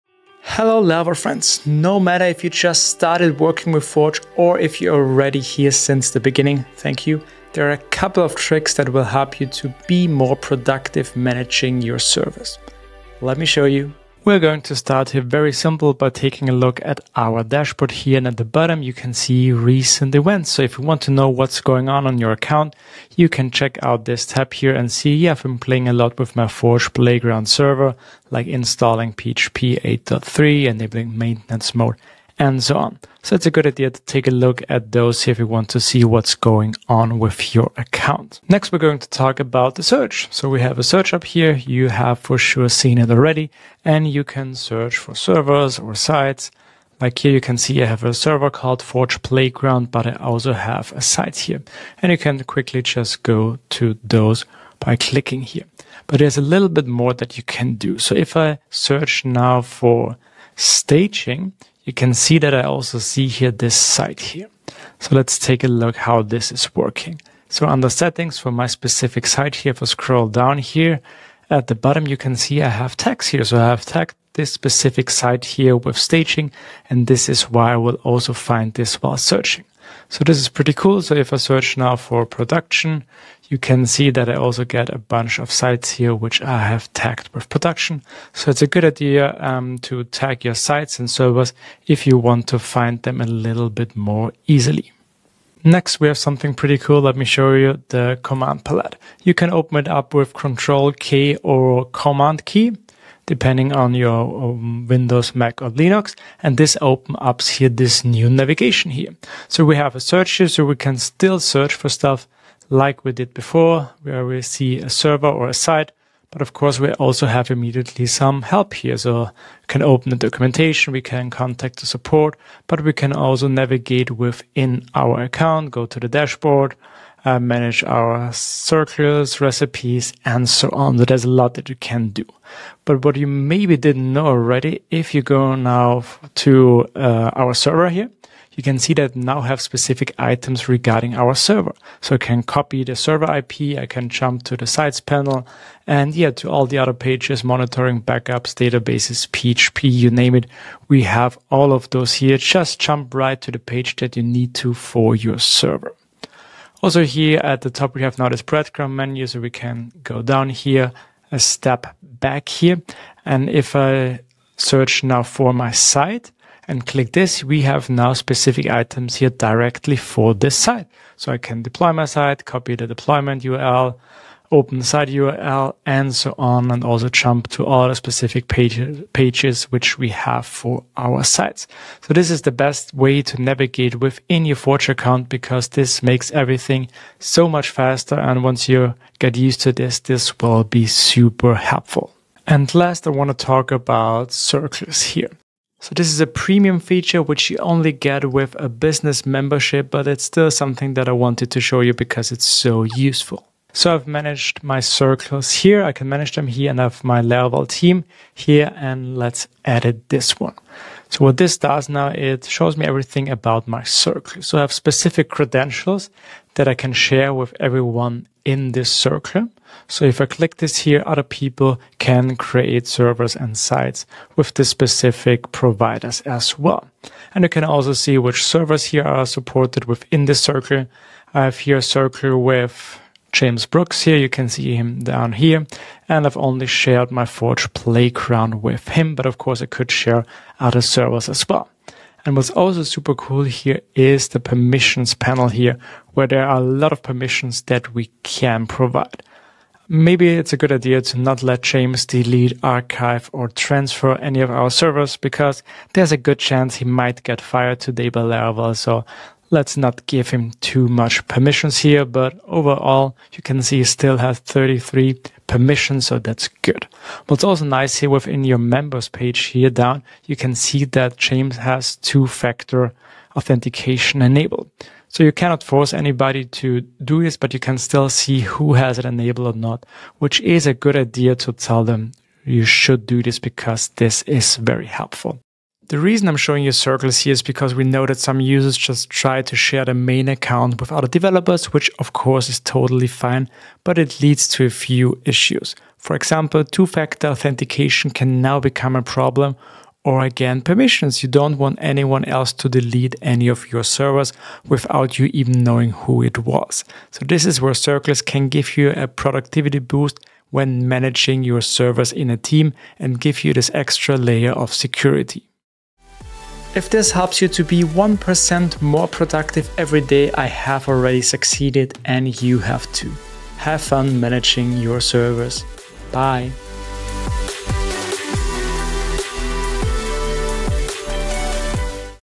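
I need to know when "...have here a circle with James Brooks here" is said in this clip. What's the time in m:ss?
3:51.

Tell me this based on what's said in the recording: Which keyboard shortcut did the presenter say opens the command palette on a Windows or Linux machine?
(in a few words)
Control K.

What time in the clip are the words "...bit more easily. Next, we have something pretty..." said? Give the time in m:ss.
1:33.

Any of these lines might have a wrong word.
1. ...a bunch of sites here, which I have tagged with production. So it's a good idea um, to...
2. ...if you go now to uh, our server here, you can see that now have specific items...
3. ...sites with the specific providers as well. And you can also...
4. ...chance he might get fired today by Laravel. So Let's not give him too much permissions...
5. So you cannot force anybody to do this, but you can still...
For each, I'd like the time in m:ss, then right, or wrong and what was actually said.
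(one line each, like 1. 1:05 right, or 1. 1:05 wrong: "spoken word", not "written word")
1. 1:24 right
2. 2:14 right
3. 3:43 right
4. 4:16 right
5. 4:35 right.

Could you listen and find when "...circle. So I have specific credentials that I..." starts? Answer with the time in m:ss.
3:33.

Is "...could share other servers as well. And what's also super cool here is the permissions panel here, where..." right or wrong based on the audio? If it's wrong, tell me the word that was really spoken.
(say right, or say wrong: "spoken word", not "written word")
right.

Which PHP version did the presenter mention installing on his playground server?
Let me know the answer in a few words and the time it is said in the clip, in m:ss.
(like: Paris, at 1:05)
8.3, at 0:29.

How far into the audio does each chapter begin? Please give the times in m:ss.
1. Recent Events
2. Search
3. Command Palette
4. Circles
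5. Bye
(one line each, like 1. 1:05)
1. 0:14
2. 0:38
3. 1:35
4. 3:12
5. 5:15.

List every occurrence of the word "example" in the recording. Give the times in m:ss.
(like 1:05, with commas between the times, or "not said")
4:56.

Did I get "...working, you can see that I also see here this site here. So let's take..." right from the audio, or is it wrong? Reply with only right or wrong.
wrong.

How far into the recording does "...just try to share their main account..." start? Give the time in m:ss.
4:48.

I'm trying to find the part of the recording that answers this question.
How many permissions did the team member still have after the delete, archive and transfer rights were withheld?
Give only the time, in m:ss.
4:24.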